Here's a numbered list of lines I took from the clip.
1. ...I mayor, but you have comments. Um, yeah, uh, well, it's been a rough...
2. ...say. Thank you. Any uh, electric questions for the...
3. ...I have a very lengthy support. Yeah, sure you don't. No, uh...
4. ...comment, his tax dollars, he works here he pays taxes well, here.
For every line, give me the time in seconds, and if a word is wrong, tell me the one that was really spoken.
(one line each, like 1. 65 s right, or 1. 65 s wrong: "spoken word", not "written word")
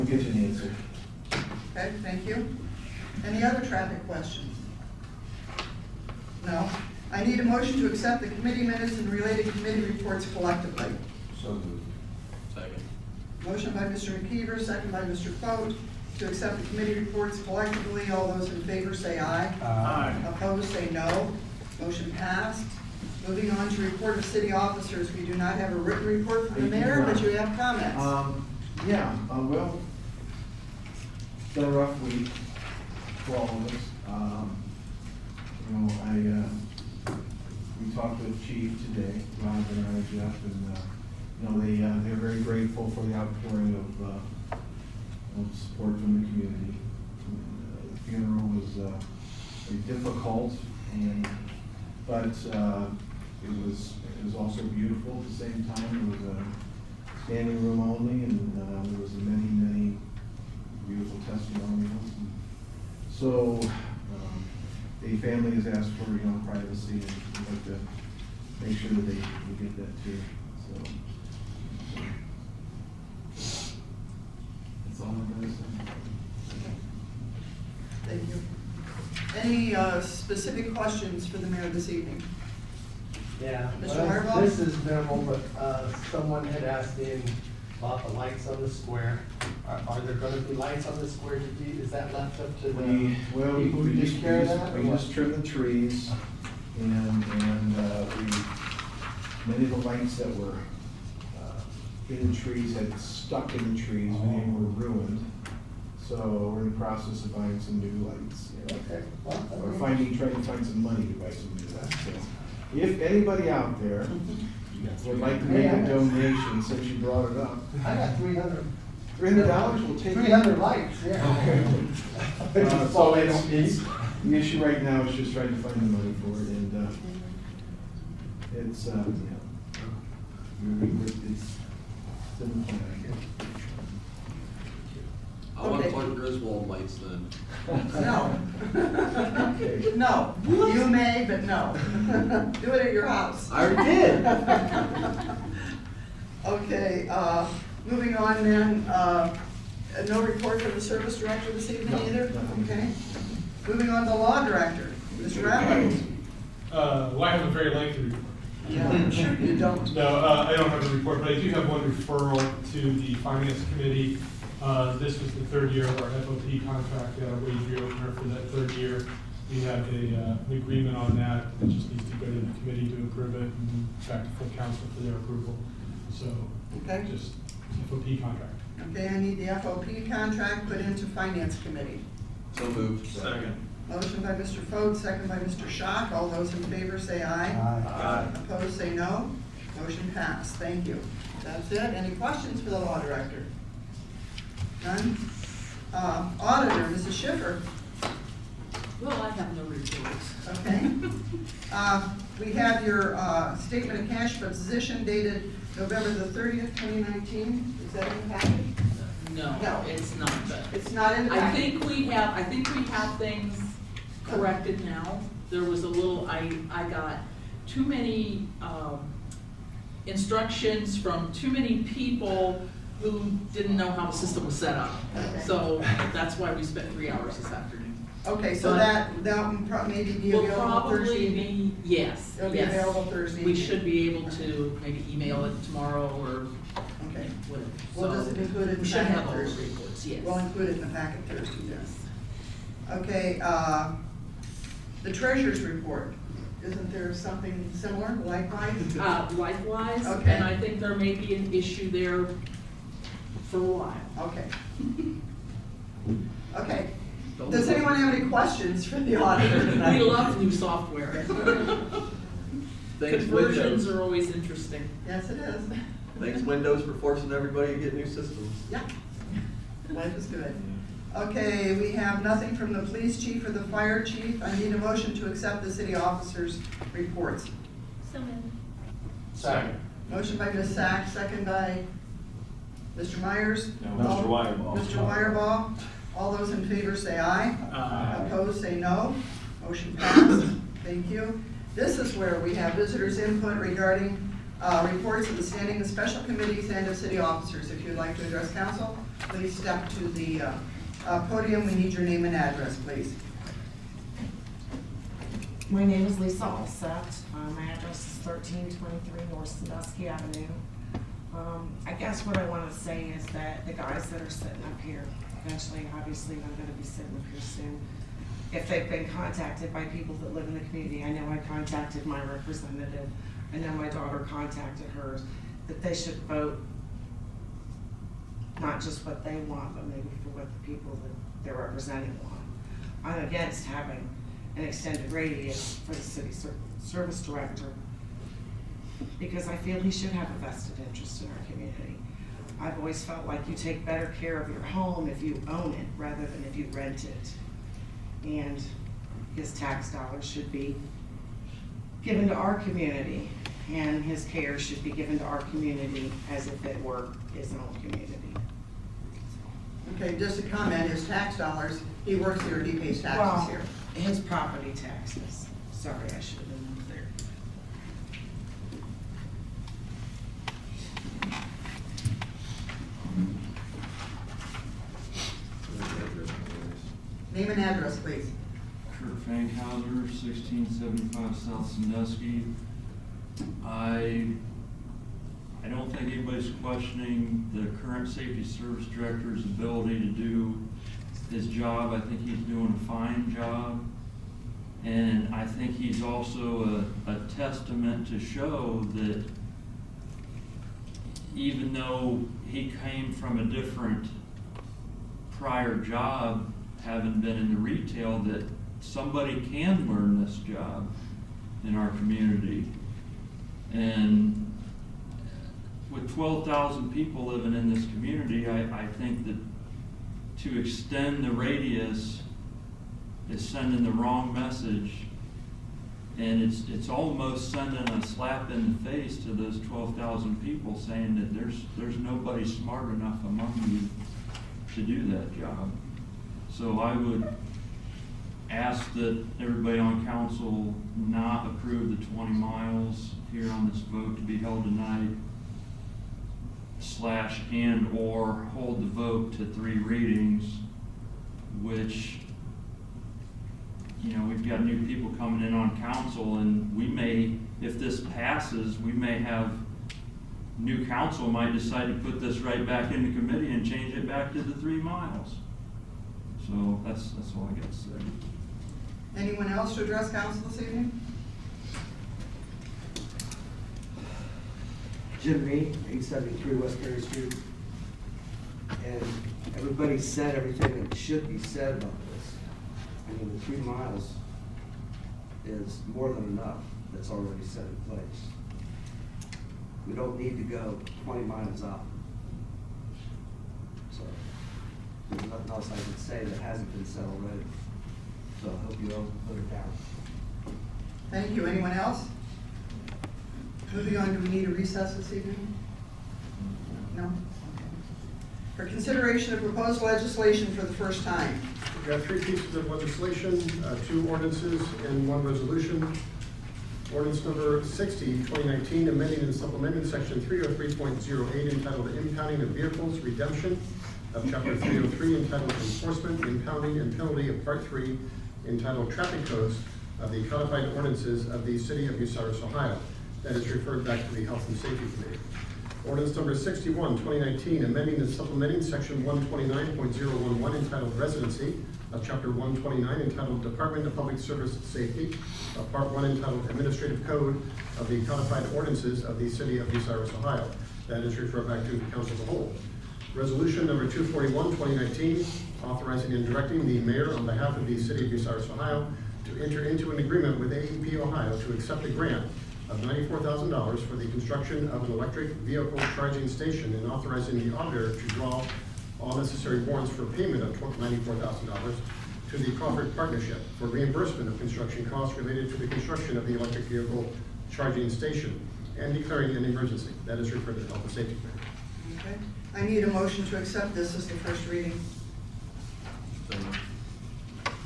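1. 26 s right
2. 75 s wrong: "specific", not "electric"
3. 157 s wrong: "report", not "support"
4. 360 s right.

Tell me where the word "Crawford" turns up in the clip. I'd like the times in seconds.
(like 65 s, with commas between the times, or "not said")
572 s.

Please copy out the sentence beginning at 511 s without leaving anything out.
We have three pieces of legislation, uh, two ordinances, and one resolution.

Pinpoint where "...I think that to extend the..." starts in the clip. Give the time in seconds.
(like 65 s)
418 s.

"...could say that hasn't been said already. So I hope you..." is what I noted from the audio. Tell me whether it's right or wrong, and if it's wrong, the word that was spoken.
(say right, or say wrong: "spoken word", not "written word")
right.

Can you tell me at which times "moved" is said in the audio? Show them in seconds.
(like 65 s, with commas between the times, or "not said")
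11 s, 182 s, 278 s.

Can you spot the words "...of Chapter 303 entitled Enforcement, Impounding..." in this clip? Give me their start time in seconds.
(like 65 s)
524 s.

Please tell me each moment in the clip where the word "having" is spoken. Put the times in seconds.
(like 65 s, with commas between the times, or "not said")
333 s, 406 s.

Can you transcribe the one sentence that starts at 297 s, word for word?
If you'd like to address council, please step to the uh, uh, podium.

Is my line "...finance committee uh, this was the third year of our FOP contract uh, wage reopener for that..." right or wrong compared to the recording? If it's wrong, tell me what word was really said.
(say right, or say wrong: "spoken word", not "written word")
right.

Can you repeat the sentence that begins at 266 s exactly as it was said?
Thanks, Windows, for forcing everybody to get new systems.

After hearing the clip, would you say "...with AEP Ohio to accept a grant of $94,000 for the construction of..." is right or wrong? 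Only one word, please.
right.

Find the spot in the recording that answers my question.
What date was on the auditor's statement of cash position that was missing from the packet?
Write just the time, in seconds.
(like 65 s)
205 s.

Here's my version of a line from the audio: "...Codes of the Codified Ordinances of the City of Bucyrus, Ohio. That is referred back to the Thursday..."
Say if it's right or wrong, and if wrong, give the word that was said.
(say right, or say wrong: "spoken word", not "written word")
wrong: "Health", not "Thursday".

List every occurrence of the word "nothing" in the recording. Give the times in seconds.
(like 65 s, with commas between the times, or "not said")
272 s, 495 s.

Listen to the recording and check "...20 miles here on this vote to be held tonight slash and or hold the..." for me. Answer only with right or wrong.
right.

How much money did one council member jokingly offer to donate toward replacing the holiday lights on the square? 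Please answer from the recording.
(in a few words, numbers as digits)
$300.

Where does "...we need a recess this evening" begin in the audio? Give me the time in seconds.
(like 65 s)
504 s.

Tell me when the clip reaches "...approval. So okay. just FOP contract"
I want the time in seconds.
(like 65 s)
175 s.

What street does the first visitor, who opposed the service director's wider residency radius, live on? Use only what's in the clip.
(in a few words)
North Sandusky Avenue.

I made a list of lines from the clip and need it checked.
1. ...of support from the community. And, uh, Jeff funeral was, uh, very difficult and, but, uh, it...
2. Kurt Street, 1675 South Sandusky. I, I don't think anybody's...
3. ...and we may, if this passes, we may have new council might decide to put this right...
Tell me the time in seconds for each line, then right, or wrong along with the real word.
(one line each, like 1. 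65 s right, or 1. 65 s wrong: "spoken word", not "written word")
1. 45 s wrong: "The", not "Jeff"
2. 378 s wrong: "Fankhauser", not "Street"
3. 456 s right.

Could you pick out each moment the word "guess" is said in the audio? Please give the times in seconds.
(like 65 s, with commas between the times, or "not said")
133 s, 311 s.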